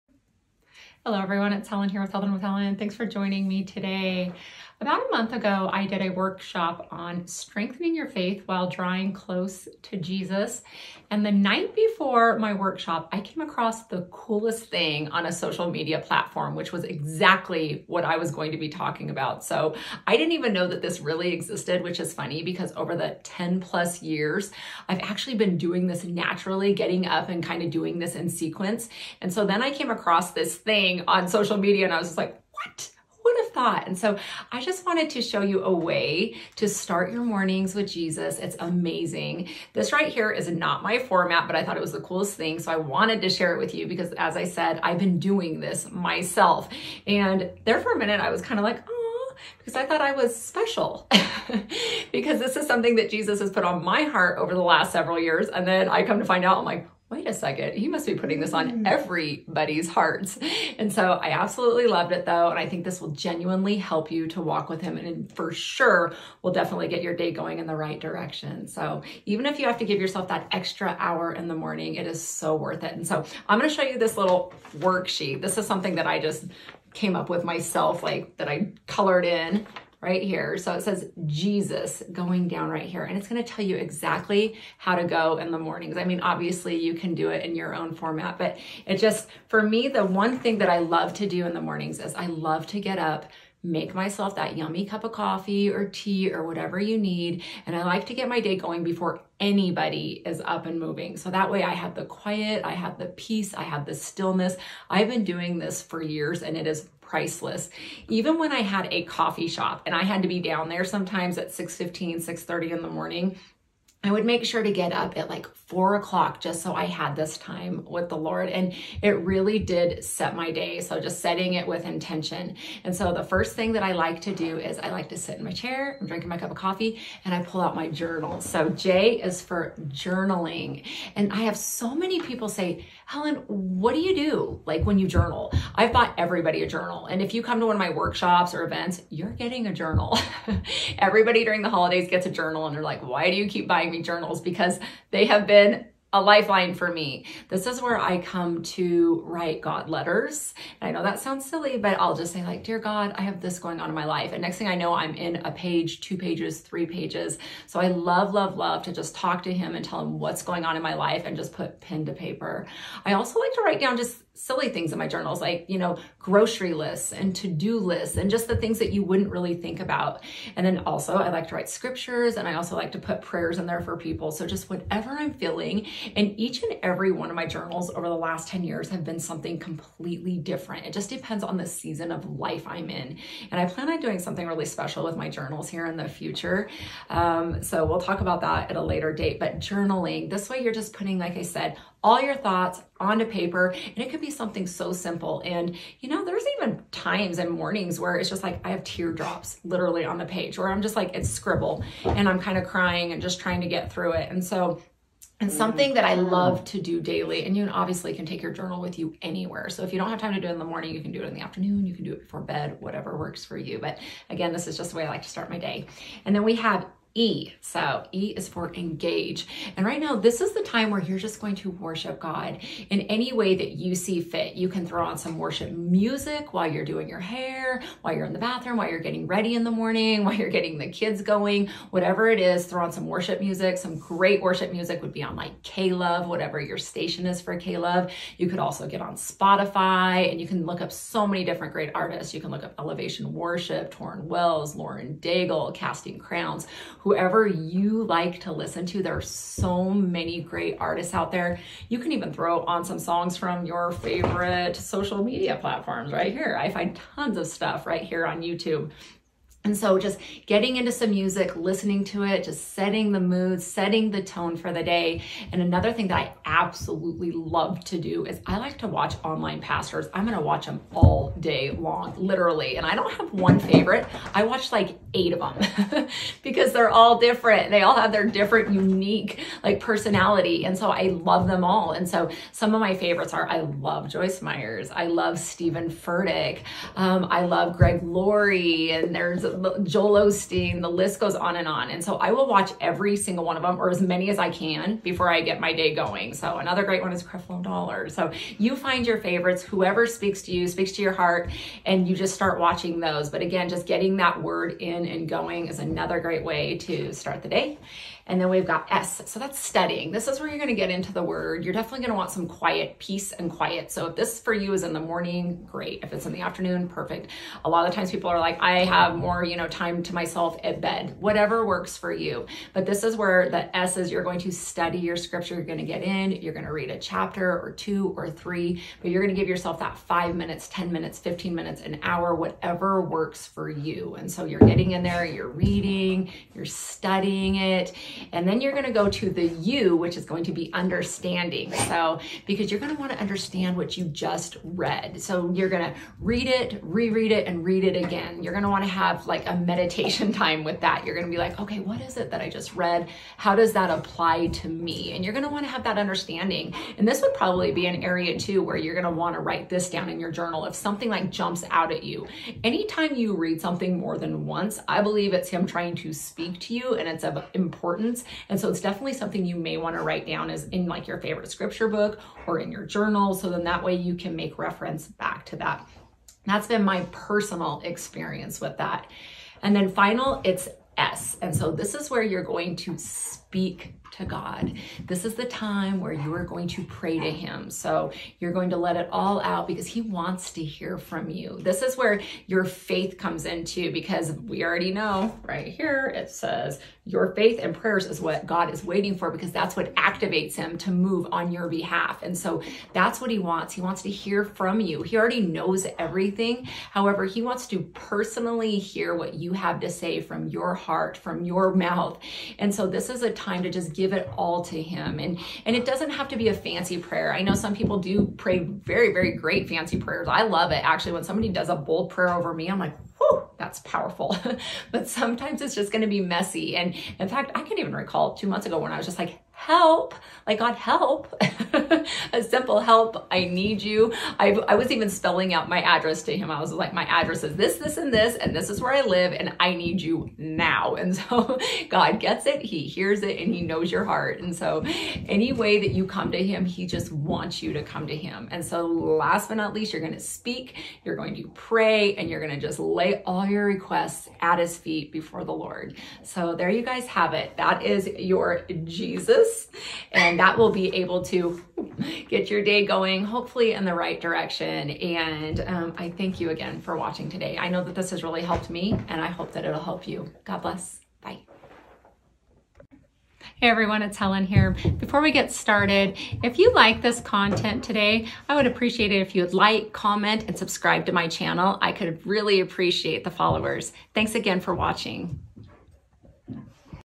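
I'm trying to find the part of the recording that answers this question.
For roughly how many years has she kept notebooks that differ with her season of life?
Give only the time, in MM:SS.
02:58.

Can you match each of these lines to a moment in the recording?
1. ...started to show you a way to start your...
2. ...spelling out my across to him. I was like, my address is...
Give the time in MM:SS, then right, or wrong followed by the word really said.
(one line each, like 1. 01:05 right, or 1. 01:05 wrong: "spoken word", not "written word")
1. 00:34 wrong: "wanted", not "started"
2. 07:15 wrong: "address", not "across".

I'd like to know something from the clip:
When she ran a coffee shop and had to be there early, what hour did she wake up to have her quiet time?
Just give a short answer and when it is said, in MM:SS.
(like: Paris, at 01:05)
4 o'clock, at 01:55.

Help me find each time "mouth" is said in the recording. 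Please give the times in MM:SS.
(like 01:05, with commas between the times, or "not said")
06:51.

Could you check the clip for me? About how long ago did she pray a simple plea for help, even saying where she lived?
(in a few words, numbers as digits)
2 months.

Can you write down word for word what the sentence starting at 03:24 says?
And so, and something that I love to do daily, and you obviously can take your journal with you anywhere.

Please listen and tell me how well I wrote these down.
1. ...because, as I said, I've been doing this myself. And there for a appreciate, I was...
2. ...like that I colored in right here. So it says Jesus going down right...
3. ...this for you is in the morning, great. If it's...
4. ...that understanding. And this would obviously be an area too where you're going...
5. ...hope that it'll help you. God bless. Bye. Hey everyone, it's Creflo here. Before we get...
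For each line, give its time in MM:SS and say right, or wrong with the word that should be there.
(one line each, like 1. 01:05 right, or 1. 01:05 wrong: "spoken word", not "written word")
1. 00:43 wrong: "minute", not "appreciate"
2. 01:18 right
3. 05:14 right
4. 05:55 wrong: "probably", not "obviously"
5. 07:49 wrong: "Helen", not "Creflo".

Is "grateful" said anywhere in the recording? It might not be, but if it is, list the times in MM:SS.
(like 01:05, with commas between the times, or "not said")
not said.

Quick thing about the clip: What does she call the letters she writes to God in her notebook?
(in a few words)
God letters.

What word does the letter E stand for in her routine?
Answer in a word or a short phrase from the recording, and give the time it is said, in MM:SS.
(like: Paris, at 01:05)
Engage, at 03:38.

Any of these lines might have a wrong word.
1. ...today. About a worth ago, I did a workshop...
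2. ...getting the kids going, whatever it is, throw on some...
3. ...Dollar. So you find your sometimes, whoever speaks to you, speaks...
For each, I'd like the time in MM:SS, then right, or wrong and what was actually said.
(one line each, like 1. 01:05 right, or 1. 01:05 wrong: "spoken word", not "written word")
1. 00:03 wrong: "month", not "worth"
2. 03:50 right
3. 04:57 wrong: "favorites", not "sometimes".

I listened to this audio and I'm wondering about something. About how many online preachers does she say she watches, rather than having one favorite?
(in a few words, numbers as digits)
8.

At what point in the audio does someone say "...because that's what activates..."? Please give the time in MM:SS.
06:39.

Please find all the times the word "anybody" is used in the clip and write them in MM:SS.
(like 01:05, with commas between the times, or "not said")
01:39.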